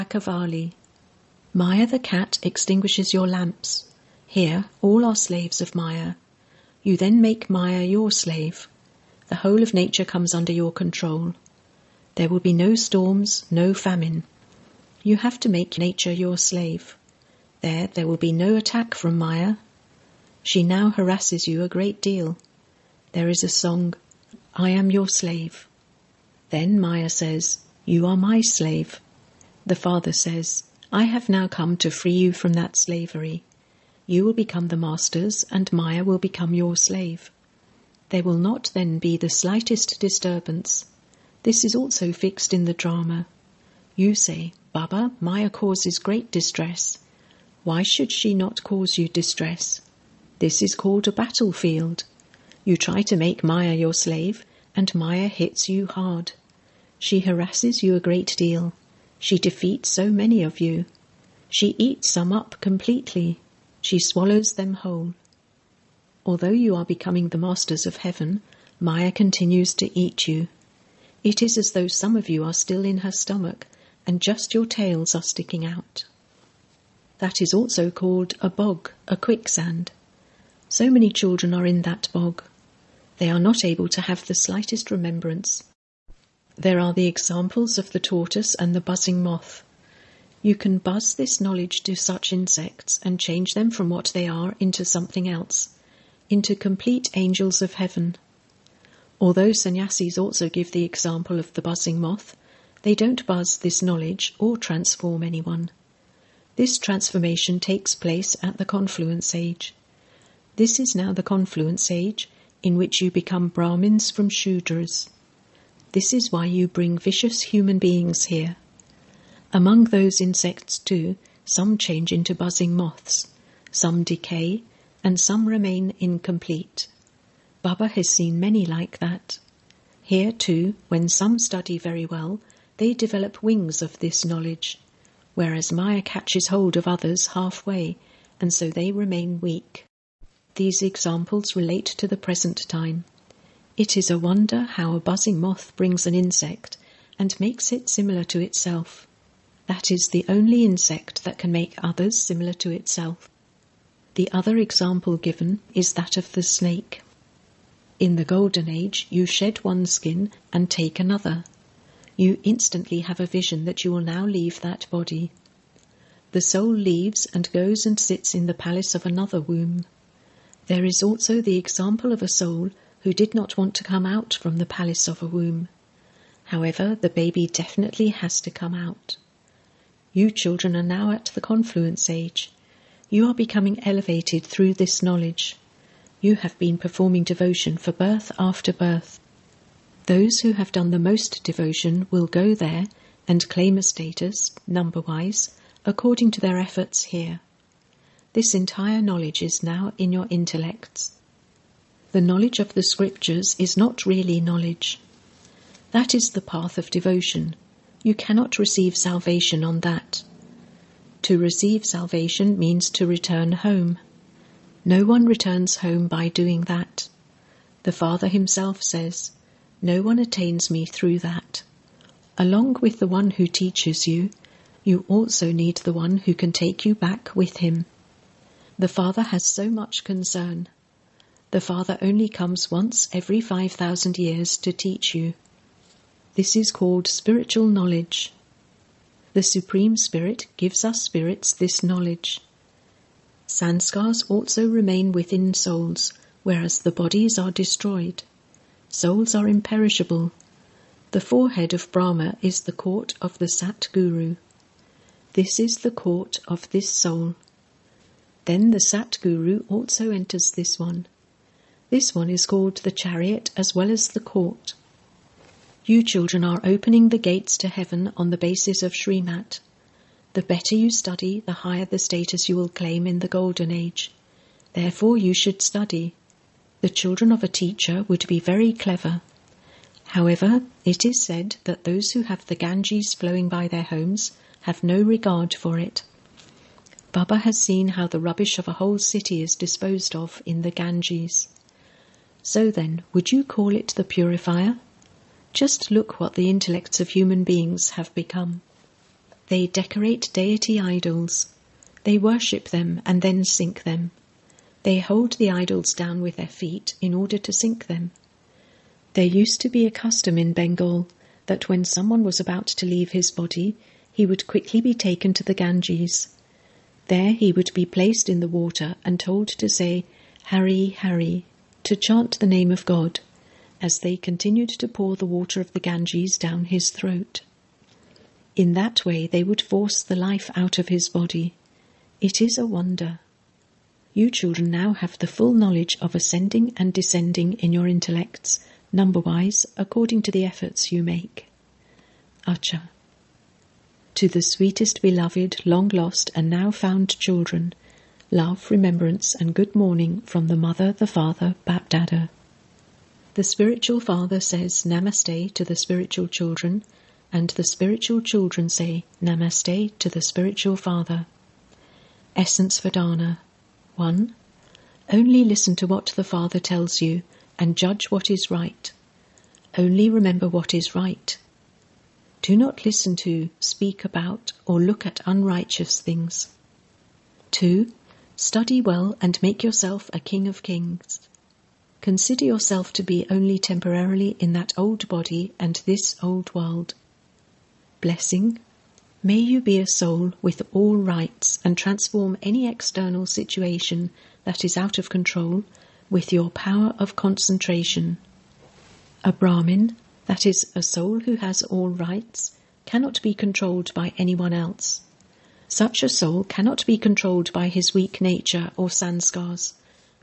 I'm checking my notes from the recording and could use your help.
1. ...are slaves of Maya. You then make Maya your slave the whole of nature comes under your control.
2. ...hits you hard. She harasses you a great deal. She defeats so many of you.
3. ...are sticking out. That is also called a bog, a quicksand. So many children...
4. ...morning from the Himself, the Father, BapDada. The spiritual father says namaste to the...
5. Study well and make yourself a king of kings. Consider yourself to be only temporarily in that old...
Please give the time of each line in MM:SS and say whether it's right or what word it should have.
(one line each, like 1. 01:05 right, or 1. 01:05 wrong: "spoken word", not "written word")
1. 00:05 right
2. 00:55 right
3. 01:15 right
4. 05:49 wrong: "Mother", not "Himself"
5. 06:18 right.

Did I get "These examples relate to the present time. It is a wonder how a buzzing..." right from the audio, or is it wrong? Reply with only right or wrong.
right.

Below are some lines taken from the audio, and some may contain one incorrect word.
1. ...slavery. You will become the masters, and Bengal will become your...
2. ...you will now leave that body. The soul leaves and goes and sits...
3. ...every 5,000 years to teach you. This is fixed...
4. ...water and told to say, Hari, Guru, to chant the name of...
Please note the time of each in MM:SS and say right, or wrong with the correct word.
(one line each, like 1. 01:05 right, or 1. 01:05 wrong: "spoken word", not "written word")
1. 00:32 wrong: "Maya", not "Bengal"
2. 02:43 right
3. 03:53 wrong: "called", not "fixed"
4. 05:18 wrong: "Hari", not "Guru".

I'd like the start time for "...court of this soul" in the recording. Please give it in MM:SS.
04:15.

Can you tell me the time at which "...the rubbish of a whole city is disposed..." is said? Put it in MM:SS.
04:48.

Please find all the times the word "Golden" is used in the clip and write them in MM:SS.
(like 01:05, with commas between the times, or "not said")
02:38, 04:33.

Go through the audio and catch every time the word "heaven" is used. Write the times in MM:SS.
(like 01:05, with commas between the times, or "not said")
01:07, 01:37, 04:27.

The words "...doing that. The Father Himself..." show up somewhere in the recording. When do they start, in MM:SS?
03:36.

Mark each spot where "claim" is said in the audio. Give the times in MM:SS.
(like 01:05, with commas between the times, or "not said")
03:13, 04:32.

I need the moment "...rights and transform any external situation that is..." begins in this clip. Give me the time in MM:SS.
06:30.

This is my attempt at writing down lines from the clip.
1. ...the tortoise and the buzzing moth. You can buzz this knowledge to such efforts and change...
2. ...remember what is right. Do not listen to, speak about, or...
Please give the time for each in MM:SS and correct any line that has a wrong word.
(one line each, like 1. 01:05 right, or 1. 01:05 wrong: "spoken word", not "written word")
1. 01:27 wrong: "insects", not "efforts"
2. 06:10 right.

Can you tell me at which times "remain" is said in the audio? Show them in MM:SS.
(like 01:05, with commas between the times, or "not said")
02:05, 02:18, 04:04.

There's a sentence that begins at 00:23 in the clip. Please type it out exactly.
There is a song, I am your slave.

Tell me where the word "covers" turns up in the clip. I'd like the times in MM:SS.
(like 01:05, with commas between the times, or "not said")
not said.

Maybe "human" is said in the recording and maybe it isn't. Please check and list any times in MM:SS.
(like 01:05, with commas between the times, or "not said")
01:57, 04:57.